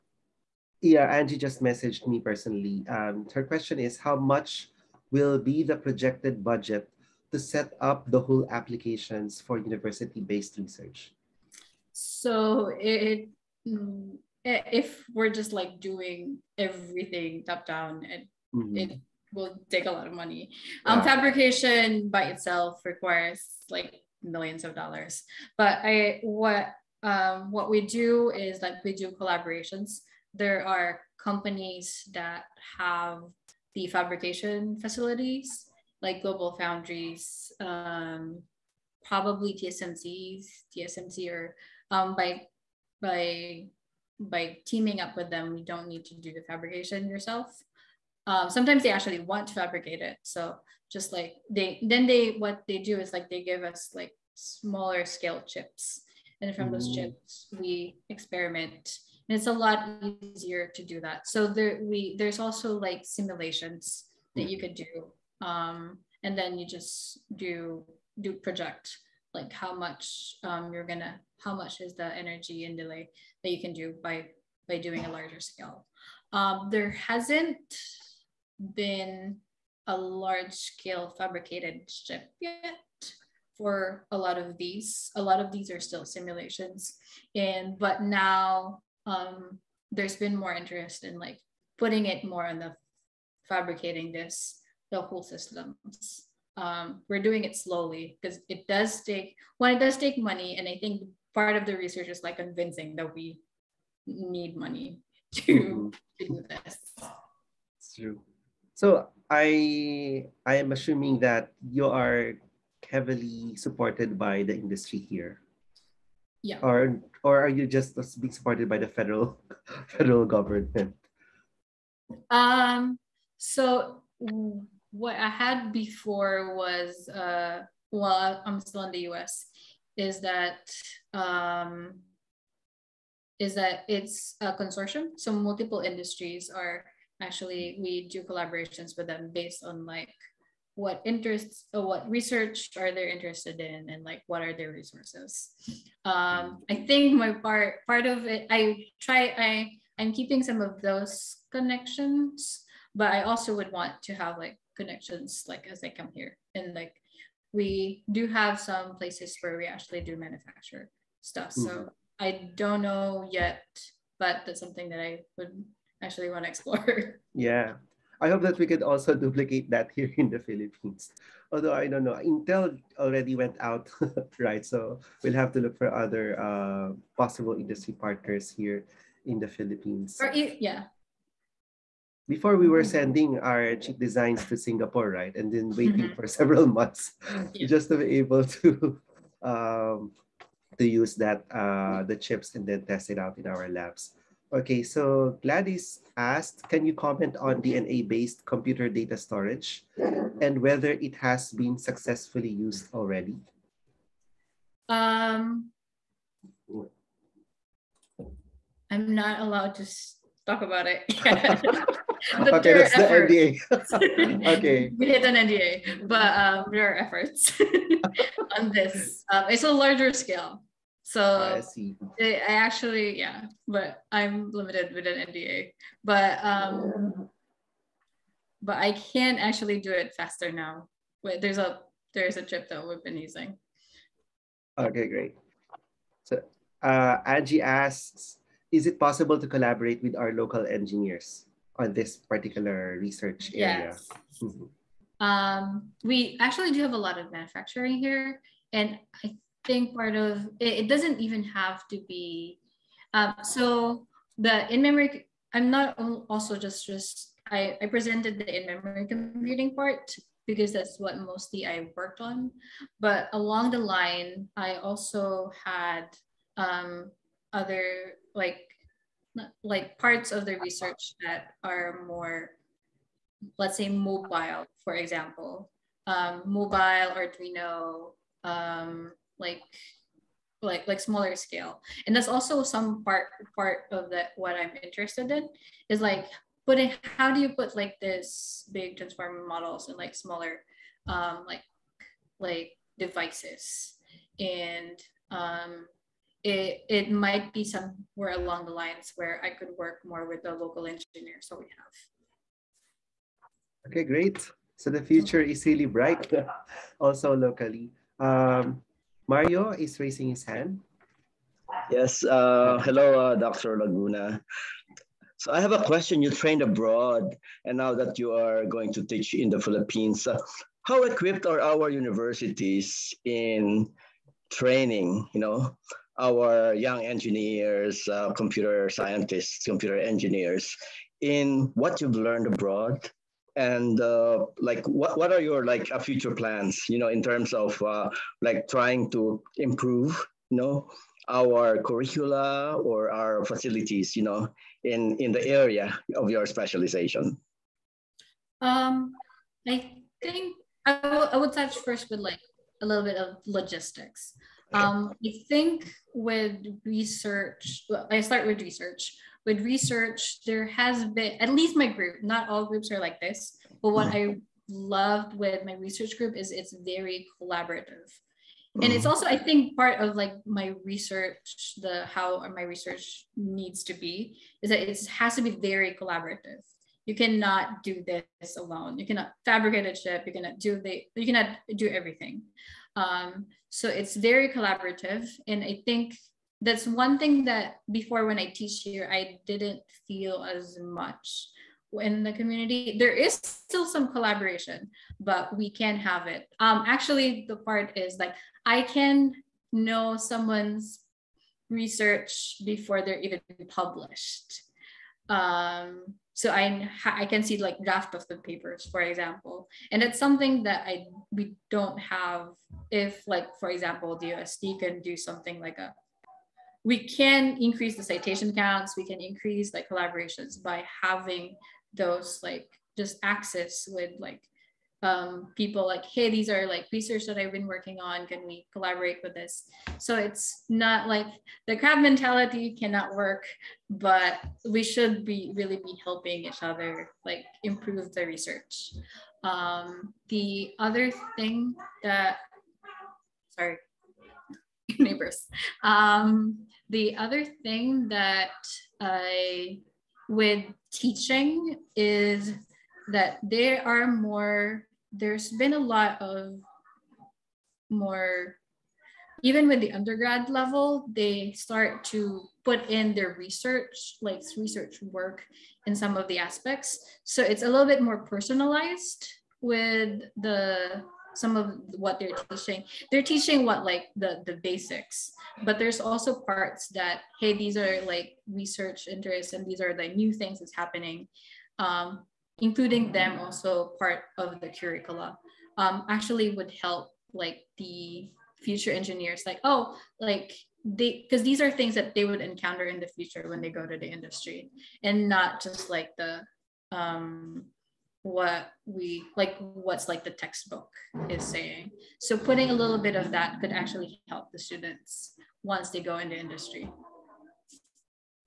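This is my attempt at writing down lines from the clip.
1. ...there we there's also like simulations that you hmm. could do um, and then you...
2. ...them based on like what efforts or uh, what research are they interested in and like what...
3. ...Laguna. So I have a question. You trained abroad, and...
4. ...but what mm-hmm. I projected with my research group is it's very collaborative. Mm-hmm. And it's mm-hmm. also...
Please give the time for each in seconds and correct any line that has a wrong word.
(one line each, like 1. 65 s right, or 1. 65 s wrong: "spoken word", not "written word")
1. 61 s right
2. 139 s wrong: "interests", not "efforts"
3. 313 s right
4. 363 s wrong: "loved", not "projected".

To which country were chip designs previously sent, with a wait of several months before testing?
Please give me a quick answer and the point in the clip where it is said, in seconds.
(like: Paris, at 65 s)
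Singapore, at 184 s.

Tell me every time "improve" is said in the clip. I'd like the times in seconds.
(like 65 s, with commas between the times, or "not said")
339 s, 437 s.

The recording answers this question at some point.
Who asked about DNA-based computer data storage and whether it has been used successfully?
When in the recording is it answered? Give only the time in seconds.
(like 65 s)
195 s.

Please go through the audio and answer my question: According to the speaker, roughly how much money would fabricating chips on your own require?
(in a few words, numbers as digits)
millions of dollars.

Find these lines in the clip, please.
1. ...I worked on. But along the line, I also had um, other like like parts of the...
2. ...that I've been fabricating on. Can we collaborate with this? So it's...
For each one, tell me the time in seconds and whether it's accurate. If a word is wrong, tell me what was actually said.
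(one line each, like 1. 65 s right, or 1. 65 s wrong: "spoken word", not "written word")
1. 261 s right
2. 427 s wrong: "working", not "fabricating".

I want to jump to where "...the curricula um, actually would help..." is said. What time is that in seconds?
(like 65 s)
484 s.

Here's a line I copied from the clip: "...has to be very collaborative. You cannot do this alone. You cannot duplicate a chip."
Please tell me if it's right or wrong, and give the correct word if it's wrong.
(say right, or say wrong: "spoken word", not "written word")
wrong: "fabricate", not "duplicate".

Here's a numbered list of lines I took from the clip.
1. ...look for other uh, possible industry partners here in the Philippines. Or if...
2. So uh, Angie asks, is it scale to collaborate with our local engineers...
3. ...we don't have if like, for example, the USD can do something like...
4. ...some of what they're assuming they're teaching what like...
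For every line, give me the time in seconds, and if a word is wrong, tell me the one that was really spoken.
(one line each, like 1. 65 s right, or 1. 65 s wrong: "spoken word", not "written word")
1. 175 s right
2. 236 s wrong: "possible", not "scale"
3. 411 s right
4. 471 s wrong: "teaching", not "assuming".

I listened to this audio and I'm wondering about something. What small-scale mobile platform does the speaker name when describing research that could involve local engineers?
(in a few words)
Arduino.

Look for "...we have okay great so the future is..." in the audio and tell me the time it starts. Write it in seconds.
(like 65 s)
301 s.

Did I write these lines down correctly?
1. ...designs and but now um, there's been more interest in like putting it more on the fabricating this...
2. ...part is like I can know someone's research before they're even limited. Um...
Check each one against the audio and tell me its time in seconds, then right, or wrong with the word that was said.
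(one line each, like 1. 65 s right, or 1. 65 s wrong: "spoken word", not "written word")
1. 86 s wrong: "simulations", not "designs"
2. 397 s wrong: "published", not "limited".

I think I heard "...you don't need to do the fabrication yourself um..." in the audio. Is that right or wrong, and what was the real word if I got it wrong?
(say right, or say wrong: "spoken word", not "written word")
right.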